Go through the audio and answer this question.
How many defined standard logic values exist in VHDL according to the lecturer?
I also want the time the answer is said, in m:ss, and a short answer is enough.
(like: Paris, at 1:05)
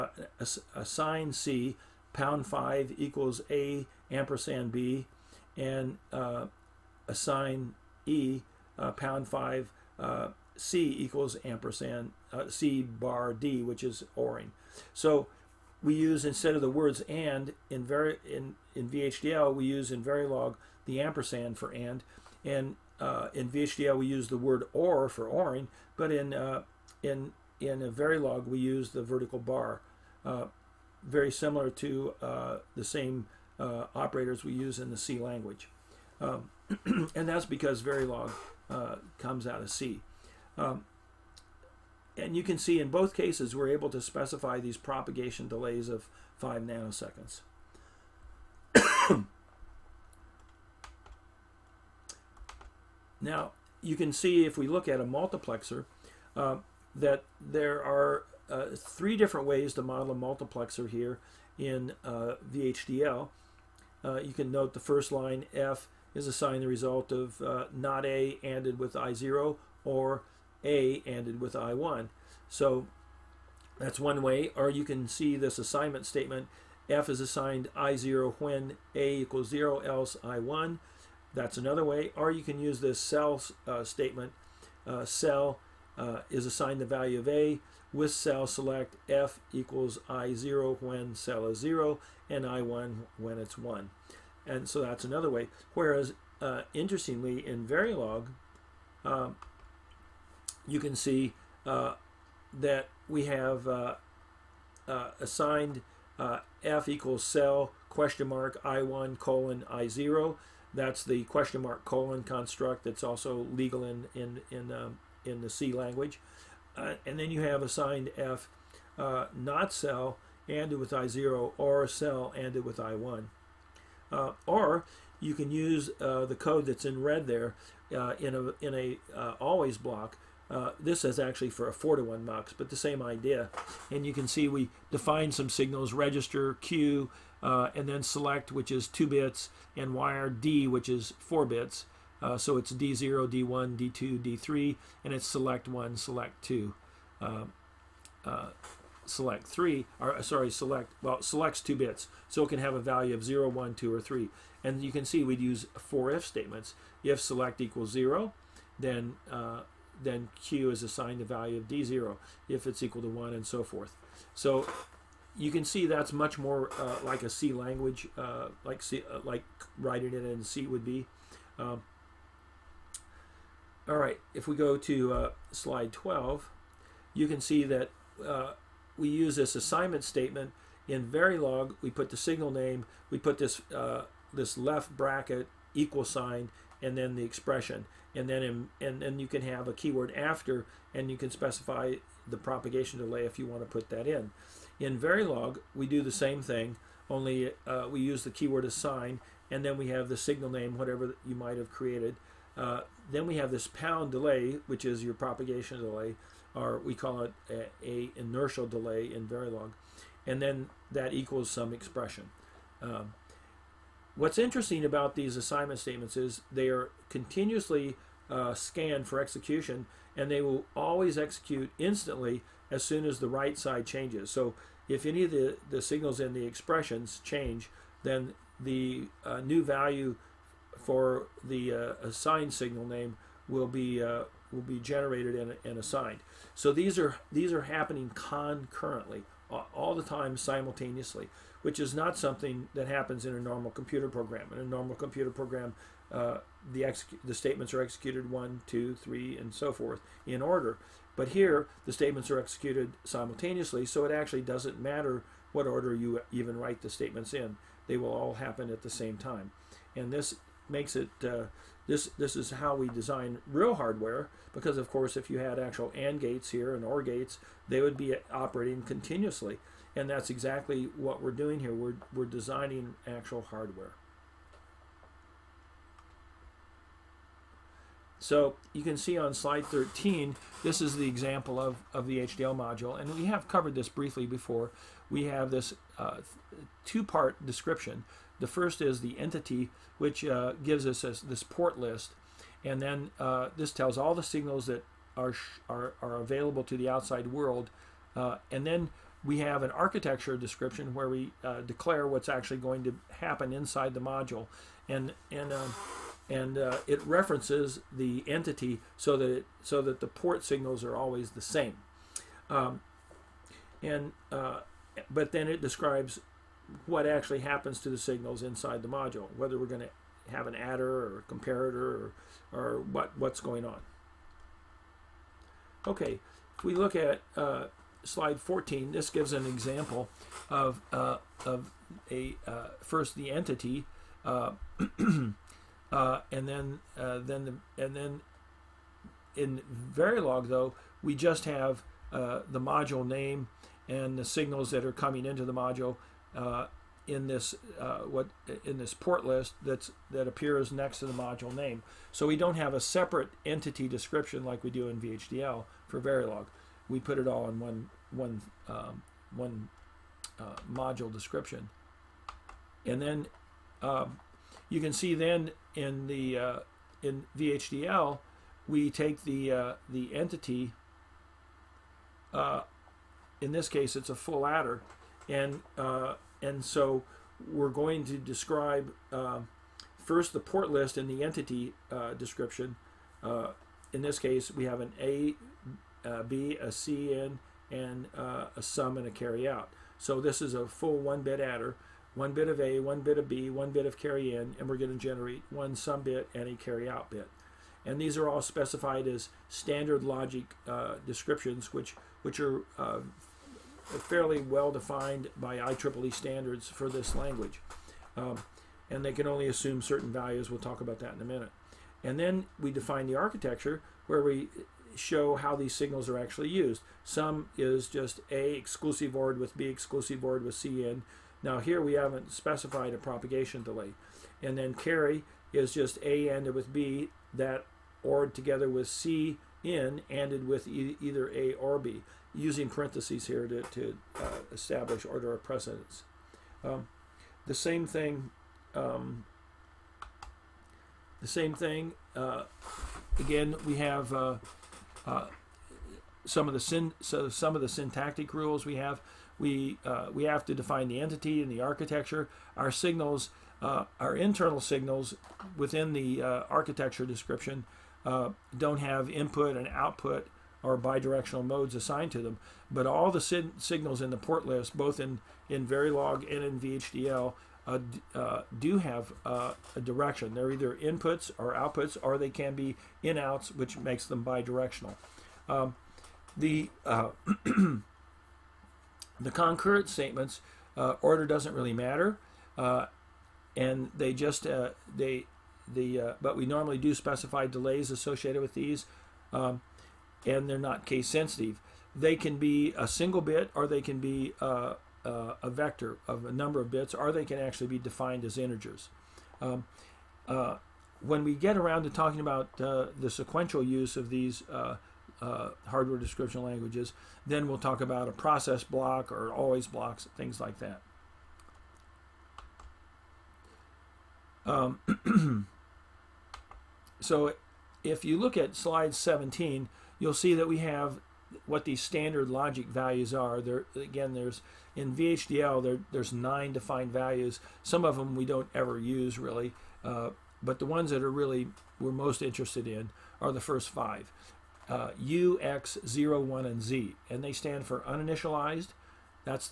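9, at 8:46.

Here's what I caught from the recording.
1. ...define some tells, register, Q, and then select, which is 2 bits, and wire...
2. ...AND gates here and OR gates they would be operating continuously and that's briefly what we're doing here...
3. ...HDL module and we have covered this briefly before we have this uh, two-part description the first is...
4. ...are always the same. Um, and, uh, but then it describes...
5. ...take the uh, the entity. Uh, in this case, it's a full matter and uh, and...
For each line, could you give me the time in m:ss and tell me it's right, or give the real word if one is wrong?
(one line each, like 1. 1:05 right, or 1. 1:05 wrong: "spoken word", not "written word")
1. 2:14 wrong: "signals", not "tells"
2. 4:25 wrong: "exactly", not "briefly"
3. 4:42 right
4. 5:10 right
5. 6:08 wrong: "adder", not "matter".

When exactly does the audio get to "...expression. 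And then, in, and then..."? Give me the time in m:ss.
3:07.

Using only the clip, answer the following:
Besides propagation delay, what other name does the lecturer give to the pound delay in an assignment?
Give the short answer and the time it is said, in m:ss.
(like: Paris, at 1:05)
inertial delay, at 3:28.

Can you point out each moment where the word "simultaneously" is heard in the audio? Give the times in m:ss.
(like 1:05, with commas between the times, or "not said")
4:00, 4:13.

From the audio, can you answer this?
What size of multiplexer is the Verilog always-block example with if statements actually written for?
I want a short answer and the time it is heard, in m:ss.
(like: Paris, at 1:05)
4 to 1 MUX, at 2:11.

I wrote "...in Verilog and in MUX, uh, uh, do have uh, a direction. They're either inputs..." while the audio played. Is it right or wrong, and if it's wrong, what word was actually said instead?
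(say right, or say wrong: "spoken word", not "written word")
wrong: "VHDL", not "MUX".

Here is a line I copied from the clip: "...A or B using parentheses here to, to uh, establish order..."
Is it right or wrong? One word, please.
right.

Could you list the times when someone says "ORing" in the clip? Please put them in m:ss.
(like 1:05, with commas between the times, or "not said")
0:14, 0:25.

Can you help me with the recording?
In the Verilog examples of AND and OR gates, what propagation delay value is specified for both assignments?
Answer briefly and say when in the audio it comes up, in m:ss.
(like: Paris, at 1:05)
5 nanoseconds, at 0:46.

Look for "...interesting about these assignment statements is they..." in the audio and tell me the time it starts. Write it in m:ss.
3:34.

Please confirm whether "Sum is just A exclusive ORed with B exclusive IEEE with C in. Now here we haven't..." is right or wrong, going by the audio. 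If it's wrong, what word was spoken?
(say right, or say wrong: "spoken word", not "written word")
wrong: "ORed", not "IEEE".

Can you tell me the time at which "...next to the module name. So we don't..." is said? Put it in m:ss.
5:50.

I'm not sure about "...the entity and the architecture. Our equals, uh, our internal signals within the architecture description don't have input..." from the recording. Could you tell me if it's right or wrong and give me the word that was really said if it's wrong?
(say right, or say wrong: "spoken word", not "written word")
wrong: "signals", not "equals".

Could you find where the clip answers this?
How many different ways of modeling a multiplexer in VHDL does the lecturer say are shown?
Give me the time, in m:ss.
0:58.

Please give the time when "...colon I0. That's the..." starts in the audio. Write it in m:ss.
1:49.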